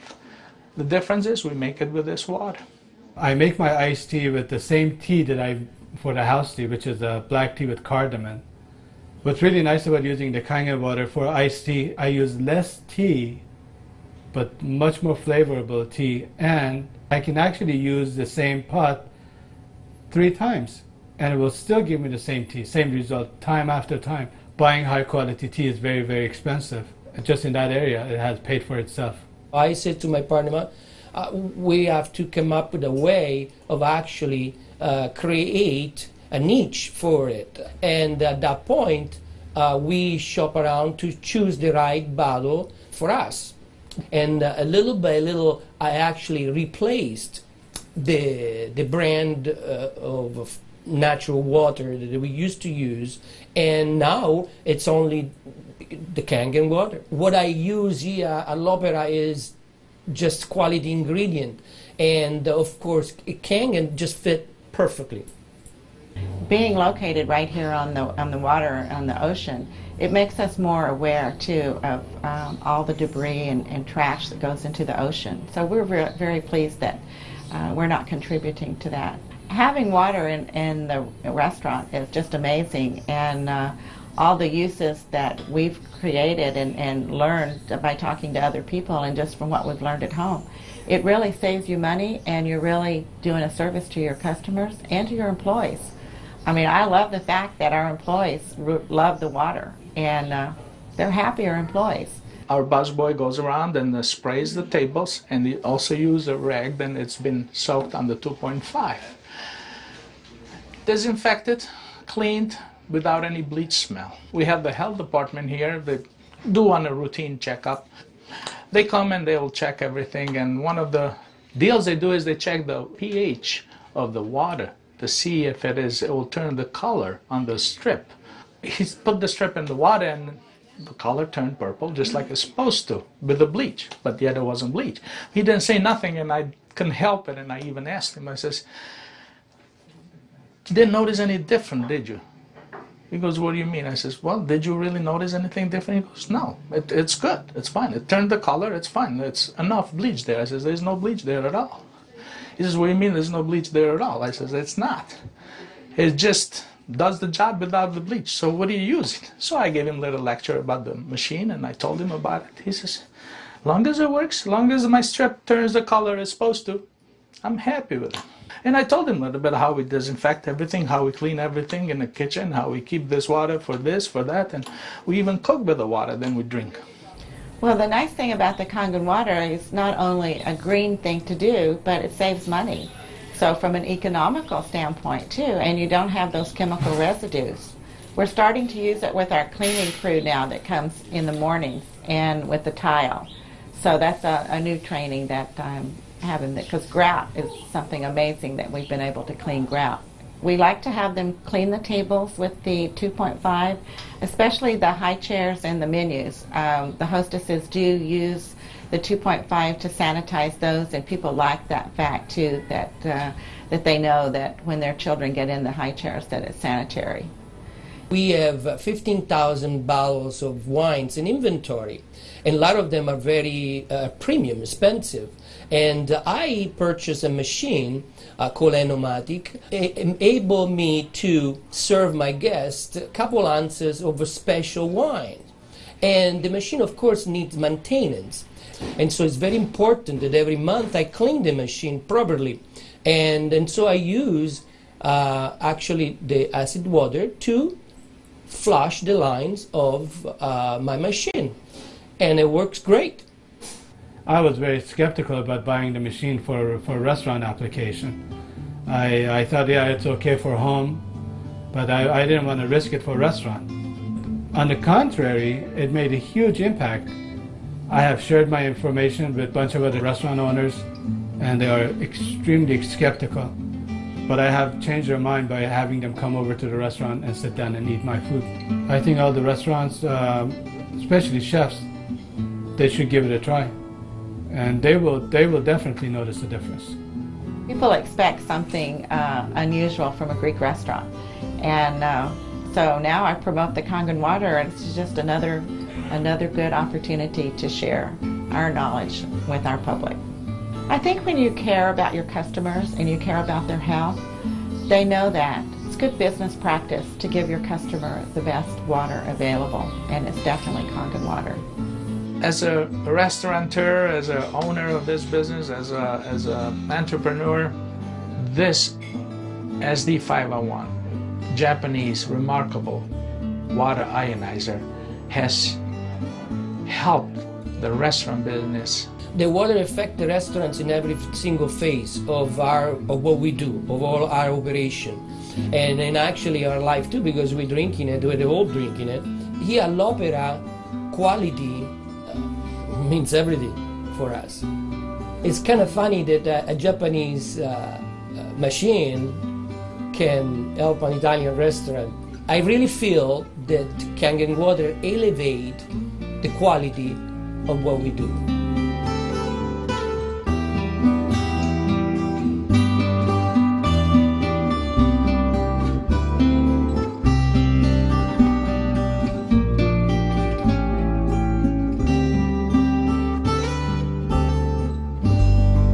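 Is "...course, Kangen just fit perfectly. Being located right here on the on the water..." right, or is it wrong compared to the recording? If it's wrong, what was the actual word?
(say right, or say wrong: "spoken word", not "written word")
right.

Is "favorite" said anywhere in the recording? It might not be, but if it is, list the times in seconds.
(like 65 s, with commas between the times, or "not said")
not said.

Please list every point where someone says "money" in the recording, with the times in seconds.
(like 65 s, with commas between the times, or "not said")
91 s, 182 s.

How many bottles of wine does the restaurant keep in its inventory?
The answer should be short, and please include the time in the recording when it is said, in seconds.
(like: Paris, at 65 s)
15,000, at 218 s.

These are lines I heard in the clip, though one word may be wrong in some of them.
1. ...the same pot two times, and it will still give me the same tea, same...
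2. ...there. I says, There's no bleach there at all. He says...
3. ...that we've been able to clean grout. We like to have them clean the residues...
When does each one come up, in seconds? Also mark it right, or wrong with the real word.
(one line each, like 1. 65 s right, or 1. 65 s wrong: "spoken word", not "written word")
1. 18 s wrong: "three", not "two"
2. 150 s right
3. 198 s wrong: "tables", not "residues".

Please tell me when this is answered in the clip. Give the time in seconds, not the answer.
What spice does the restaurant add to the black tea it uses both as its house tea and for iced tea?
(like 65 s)
7 s.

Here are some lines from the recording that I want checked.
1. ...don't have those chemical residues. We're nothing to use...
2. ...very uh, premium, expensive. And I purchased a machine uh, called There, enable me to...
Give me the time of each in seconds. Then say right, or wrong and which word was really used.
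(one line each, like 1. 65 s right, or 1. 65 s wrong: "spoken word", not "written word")
1. 185 s wrong: "starting", not "nothing"
2. 223 s wrong: "Enomatic", not "There".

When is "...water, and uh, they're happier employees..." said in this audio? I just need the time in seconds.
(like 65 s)
99 s.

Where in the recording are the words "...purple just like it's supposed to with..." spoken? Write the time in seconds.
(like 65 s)
131 s.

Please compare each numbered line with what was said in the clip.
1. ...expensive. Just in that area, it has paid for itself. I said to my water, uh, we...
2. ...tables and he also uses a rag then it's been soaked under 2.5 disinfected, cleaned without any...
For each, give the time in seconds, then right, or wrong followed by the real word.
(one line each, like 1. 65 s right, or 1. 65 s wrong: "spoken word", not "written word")
1. 26 s wrong: "partner", not "water"
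2. 104 s right.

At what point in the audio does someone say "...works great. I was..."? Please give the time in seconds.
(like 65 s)
252 s.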